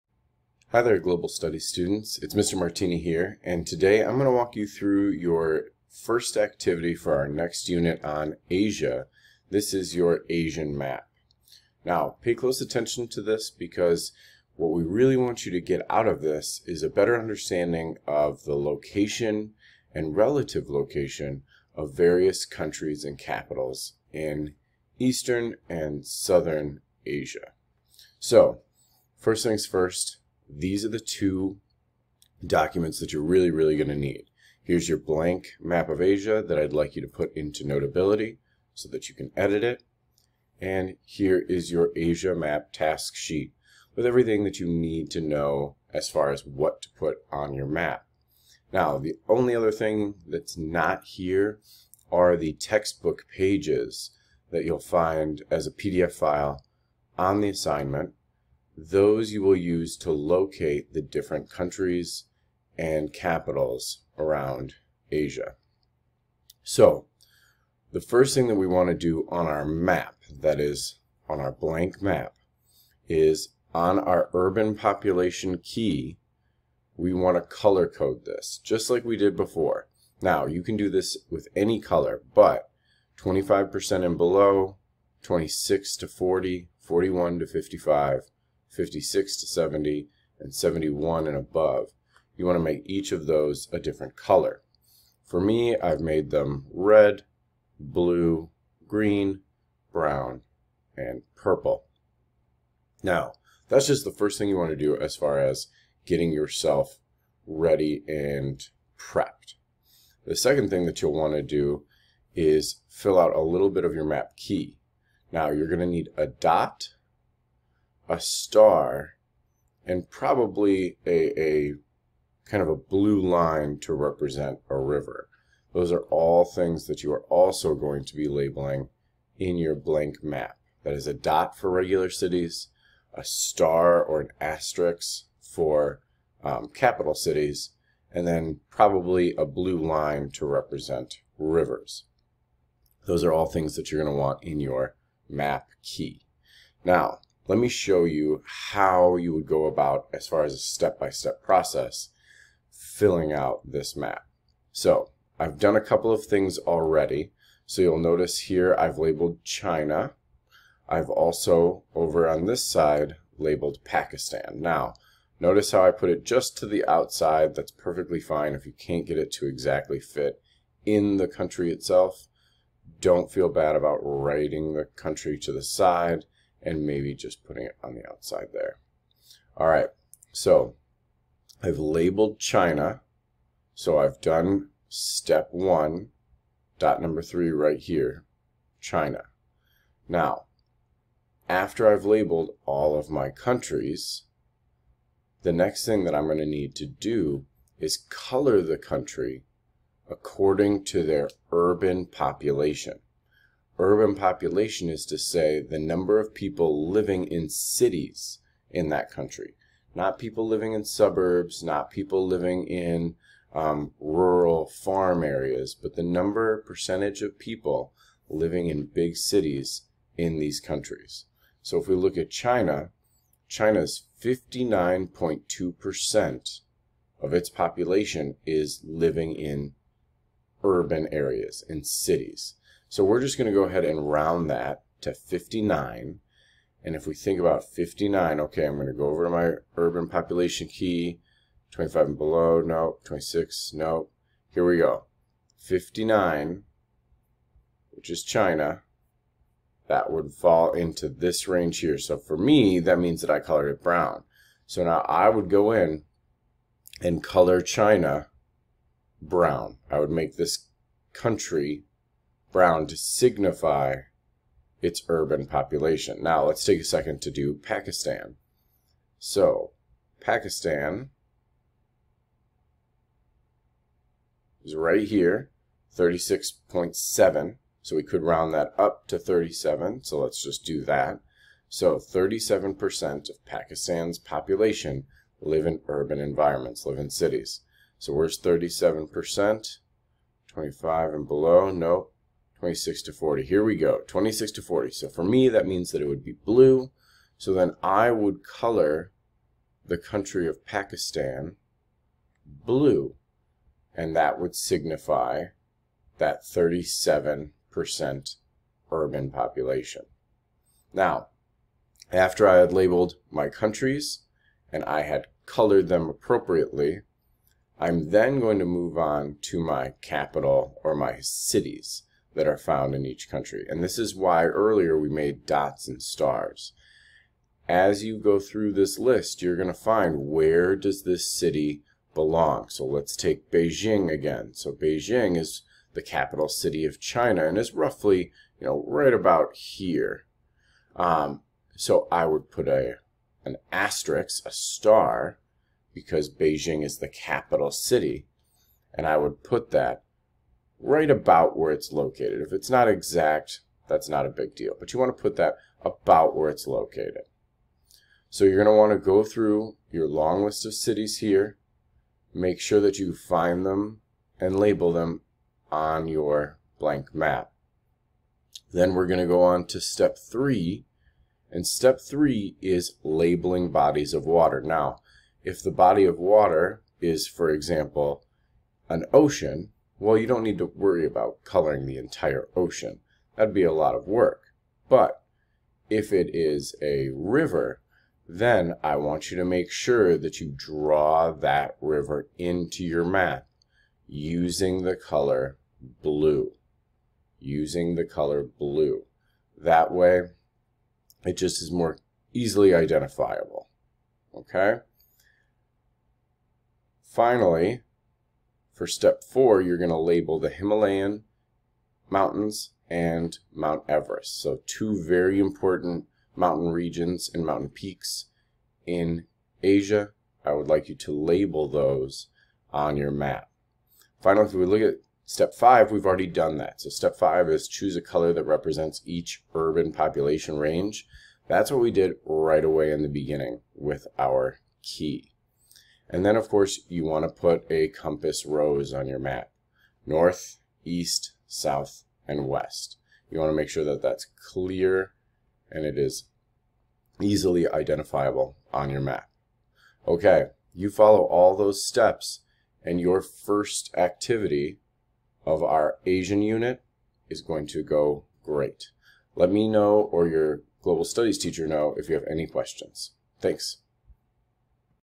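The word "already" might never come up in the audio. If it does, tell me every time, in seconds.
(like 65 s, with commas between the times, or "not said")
156 s, 426 s.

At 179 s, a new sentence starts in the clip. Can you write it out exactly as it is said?
All right, so I've labeled China.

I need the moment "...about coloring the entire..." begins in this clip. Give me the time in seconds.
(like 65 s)
381 s.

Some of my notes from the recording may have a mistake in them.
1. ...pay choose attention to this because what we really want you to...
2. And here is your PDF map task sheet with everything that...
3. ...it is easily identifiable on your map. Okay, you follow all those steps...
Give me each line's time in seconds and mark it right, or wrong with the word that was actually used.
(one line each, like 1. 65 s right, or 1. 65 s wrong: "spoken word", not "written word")
1. 12 s wrong: "close", not "choose"
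2. 40 s wrong: "Asia", not "PDF"
3. 445 s right.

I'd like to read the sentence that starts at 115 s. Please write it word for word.
Now, you're going to need a dot a star and probably a, a kind of a blue line to represent a river.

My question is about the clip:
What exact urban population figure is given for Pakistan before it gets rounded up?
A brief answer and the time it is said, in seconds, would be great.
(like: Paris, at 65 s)
36.7, at 275 s.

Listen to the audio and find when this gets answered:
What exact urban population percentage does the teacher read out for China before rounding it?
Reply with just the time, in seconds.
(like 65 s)
224 s.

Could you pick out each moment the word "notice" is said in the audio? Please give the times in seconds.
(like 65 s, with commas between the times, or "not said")
158 s, 165 s.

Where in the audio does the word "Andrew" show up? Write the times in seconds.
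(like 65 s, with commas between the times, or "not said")
not said.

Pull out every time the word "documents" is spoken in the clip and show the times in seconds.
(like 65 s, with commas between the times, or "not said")
32 s.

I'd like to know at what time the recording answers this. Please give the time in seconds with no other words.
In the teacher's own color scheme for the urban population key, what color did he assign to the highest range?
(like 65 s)
101 s.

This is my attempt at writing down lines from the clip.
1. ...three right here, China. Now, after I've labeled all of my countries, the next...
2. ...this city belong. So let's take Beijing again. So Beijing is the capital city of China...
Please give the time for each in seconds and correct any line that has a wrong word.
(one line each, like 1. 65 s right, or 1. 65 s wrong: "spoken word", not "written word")
1. 187 s right
2. 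331 s right.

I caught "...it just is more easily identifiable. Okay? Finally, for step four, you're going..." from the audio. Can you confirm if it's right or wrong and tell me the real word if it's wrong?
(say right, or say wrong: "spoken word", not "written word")
right.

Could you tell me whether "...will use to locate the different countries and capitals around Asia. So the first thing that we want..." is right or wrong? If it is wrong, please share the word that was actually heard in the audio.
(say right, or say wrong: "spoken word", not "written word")
right.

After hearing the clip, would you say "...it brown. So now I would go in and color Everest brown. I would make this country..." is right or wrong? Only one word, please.
wrong.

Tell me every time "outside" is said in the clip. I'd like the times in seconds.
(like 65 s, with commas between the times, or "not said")
166 s, 178 s.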